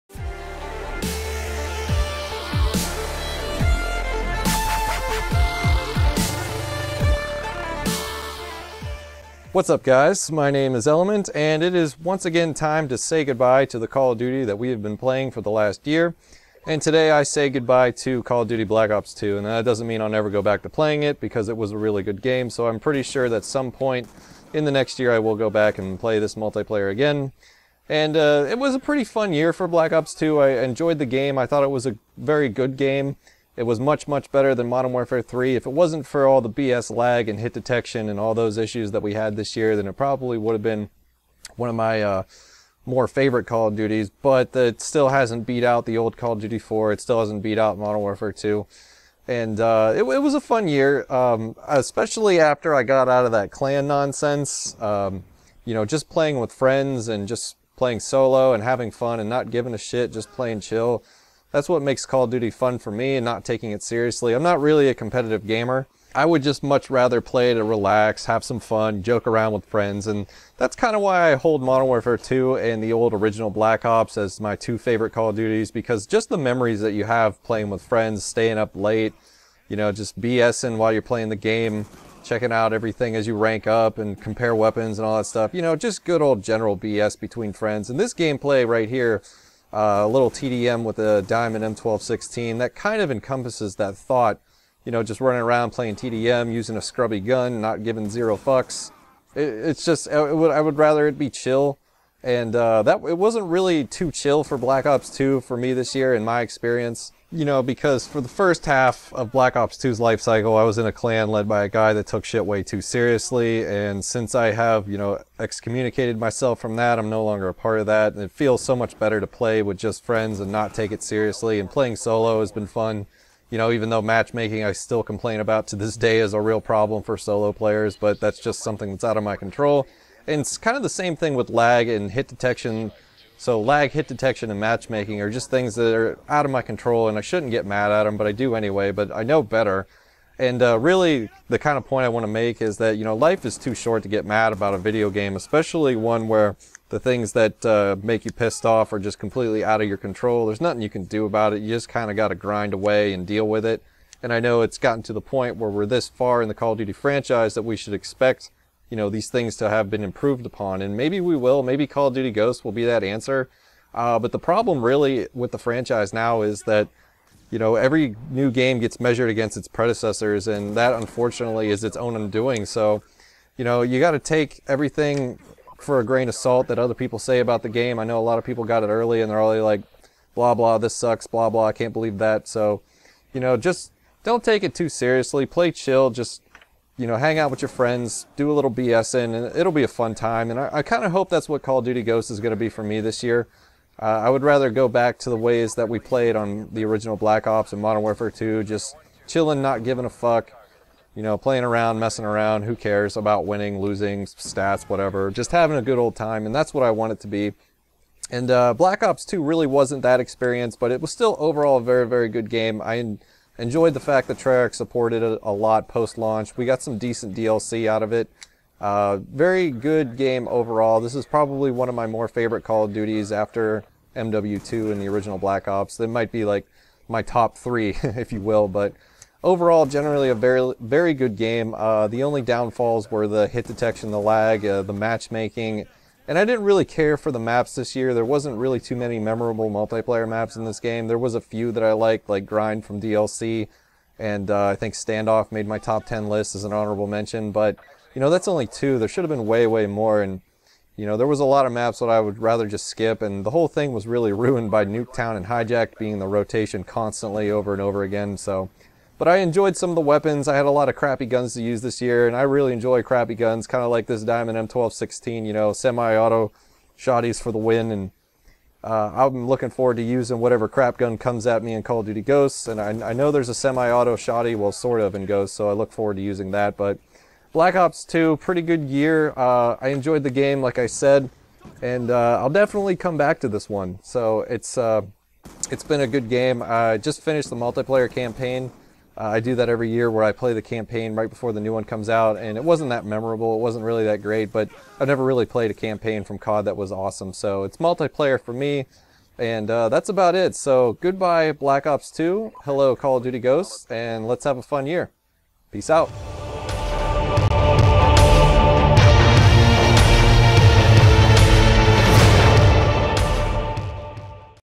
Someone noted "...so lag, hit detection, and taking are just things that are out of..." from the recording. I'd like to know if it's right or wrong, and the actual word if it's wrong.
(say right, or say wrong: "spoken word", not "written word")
wrong: "matchmaking", not "taking".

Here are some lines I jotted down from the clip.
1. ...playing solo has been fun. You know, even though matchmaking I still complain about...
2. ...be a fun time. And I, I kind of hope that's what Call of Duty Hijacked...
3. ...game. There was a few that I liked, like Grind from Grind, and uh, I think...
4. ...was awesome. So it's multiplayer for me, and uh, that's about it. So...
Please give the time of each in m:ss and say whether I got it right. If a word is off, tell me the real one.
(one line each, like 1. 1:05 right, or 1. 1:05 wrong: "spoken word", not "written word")
1. 2:01 right
2. 3:09 wrong: "Ghosts", not "Hijacked"
3. 4:00 wrong: "DLC", not "Grind"
4. 4:56 right.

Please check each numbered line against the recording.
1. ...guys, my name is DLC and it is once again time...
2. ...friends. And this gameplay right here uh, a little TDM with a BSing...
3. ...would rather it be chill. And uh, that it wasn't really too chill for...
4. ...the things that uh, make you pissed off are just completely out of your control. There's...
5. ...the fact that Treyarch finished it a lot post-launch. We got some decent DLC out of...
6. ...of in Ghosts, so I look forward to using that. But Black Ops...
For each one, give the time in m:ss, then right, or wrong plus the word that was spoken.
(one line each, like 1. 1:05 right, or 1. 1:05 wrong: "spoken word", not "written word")
1. 0:09 wrong: "Element", not "DLC"
2. 1:27 wrong: "Diamond", not "BSing"
3. 1:40 right
4. 2:26 right
5. 3:33 wrong: "supported", not "finished"
6. 4:35 right.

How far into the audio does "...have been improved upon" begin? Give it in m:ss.
2:39.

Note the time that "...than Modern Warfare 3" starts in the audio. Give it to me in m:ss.
0:34.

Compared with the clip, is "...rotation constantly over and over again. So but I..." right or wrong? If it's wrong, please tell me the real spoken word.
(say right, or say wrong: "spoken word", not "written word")
right.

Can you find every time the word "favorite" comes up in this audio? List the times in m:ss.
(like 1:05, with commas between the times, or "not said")
0:43, 1:14, 3:42.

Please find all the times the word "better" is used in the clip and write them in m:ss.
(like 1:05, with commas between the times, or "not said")
0:34, 1:58, 2:19.